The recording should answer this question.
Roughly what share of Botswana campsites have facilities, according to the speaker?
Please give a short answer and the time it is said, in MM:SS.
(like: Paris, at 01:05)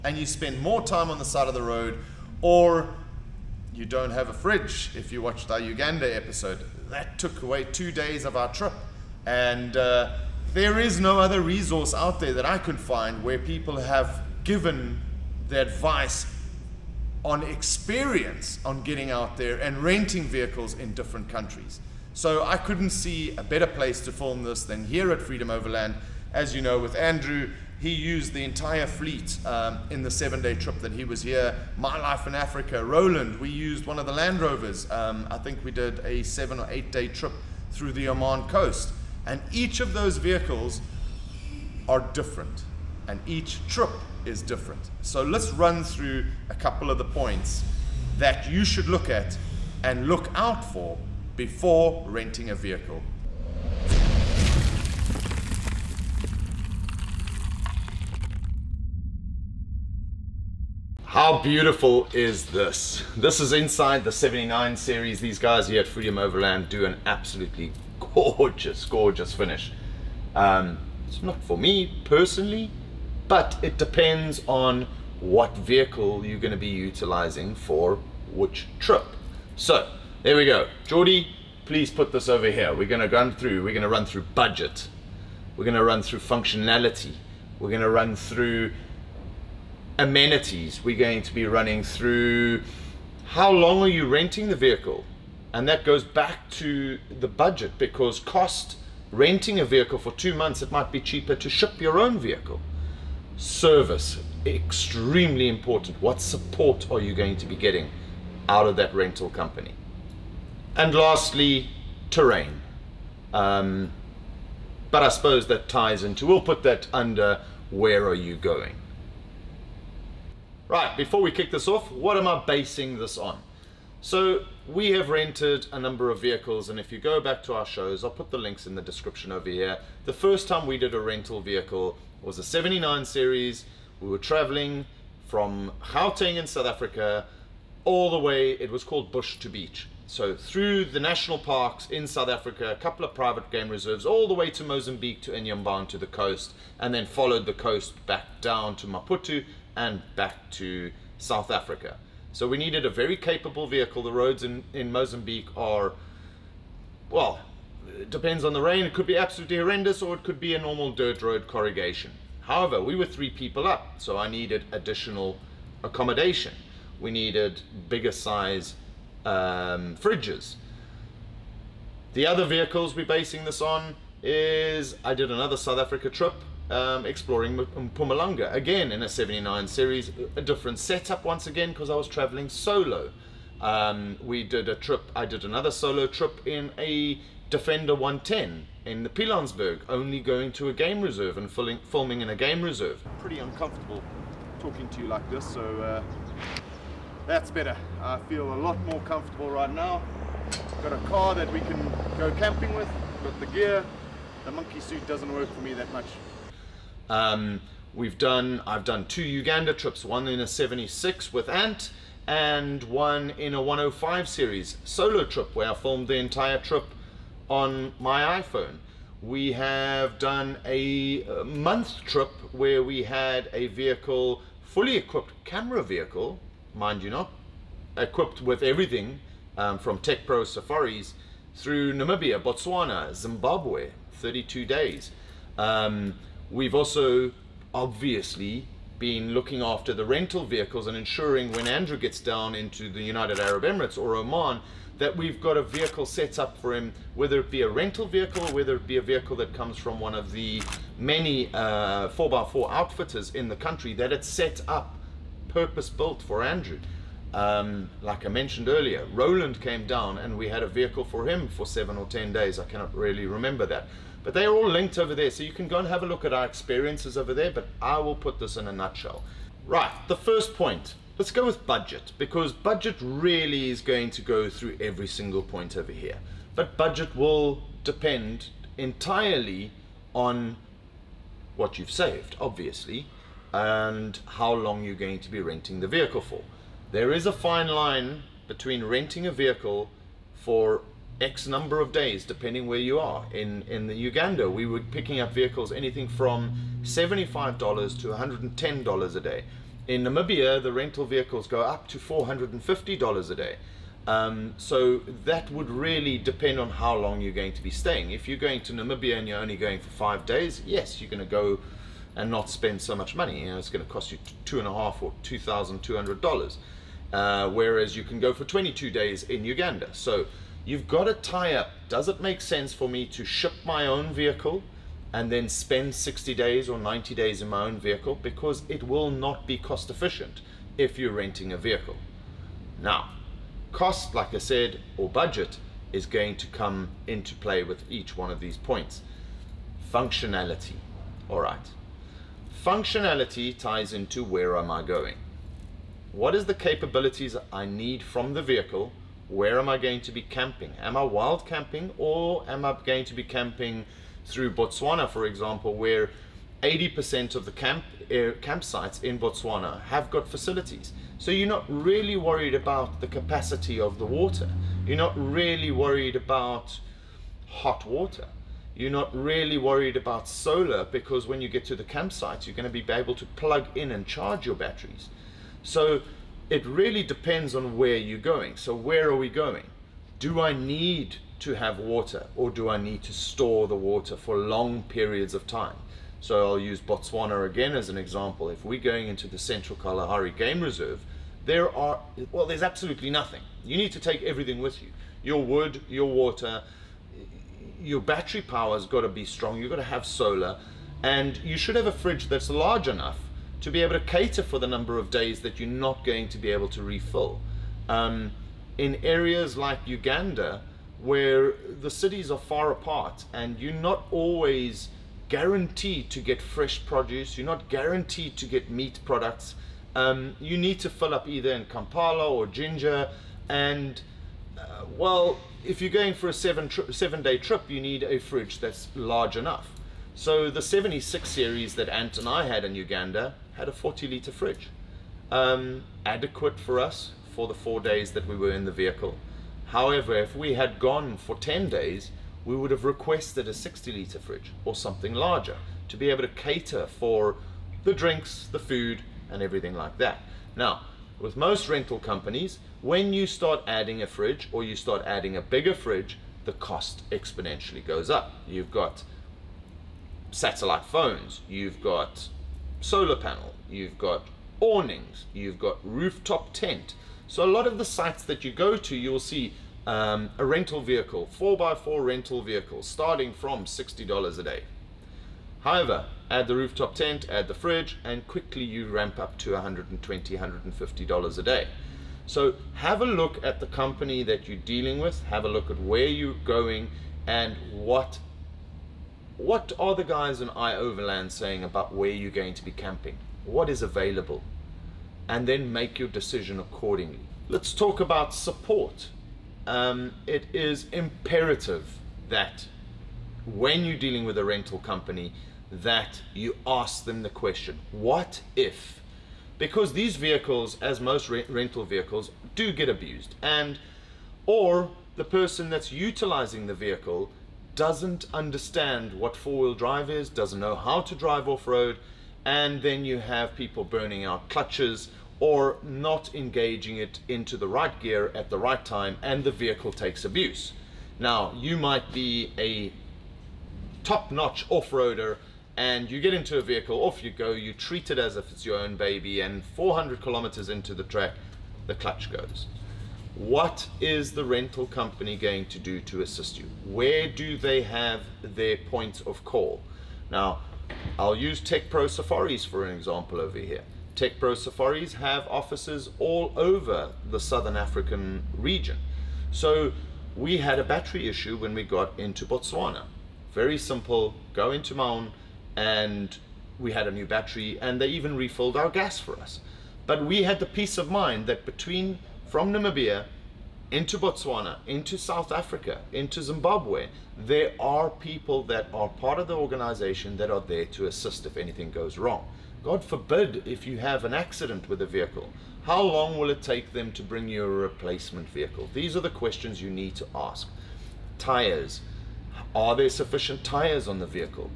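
80%, at 05:56.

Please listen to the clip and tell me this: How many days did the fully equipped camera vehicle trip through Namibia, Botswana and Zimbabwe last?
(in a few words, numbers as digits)
32 days.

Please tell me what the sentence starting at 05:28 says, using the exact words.
Because it will not be cost efficient if you're renting a vehicle.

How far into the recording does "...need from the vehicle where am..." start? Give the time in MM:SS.
05:47.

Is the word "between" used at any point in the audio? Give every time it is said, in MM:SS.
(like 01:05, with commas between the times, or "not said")
04:48, 09:31.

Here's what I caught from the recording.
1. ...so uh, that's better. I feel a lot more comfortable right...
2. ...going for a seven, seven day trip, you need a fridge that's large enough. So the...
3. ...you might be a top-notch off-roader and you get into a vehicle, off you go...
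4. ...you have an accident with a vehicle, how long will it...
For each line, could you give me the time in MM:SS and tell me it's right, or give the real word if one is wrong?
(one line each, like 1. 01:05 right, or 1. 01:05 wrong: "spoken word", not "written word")
1. 03:15 right
2. 07:05 right
3. 08:51 right
4. 09:43 right.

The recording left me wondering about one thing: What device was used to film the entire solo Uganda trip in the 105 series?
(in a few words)
iPhone.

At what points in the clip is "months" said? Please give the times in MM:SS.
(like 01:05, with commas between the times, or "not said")
01:40, 03:41.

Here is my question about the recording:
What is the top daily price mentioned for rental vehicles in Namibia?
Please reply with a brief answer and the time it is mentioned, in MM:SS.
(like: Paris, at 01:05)
$450, at 05:01.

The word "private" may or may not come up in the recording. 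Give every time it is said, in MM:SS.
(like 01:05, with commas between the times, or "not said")
02:23.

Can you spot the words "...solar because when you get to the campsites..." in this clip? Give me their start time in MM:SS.
06:10.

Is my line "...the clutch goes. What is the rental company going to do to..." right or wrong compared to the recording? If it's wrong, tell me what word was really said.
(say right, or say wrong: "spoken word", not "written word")
right.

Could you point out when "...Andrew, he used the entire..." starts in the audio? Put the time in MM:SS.
00:26.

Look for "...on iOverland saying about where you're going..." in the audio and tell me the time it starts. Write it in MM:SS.
08:10.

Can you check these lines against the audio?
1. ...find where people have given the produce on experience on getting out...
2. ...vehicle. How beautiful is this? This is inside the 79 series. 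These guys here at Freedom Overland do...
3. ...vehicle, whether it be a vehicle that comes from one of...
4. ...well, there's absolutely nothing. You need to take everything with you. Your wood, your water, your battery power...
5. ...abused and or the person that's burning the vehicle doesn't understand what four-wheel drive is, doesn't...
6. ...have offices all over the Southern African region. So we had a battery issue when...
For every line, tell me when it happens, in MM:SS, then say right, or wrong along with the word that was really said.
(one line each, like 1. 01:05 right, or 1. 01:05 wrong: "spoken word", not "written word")
1. 00:12 wrong: "advice", not "produce"
2. 00:52 right
3. 04:08 right
4. 06:32 right
5. 08:32 wrong: "utilizing", not "burning"
6. 09:15 right.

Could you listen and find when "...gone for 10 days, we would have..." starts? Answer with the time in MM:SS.
07:20.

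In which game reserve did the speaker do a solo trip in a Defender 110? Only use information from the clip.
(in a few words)
Pilansberg.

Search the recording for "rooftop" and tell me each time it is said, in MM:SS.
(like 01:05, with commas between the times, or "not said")
07:45, 07:56.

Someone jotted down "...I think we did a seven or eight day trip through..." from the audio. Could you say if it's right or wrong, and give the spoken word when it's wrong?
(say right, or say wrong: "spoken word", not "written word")
right.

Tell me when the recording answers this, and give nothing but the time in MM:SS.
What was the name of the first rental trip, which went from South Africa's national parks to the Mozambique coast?
02:19.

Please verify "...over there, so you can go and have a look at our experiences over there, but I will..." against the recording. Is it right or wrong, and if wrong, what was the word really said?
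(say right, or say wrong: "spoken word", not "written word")
right.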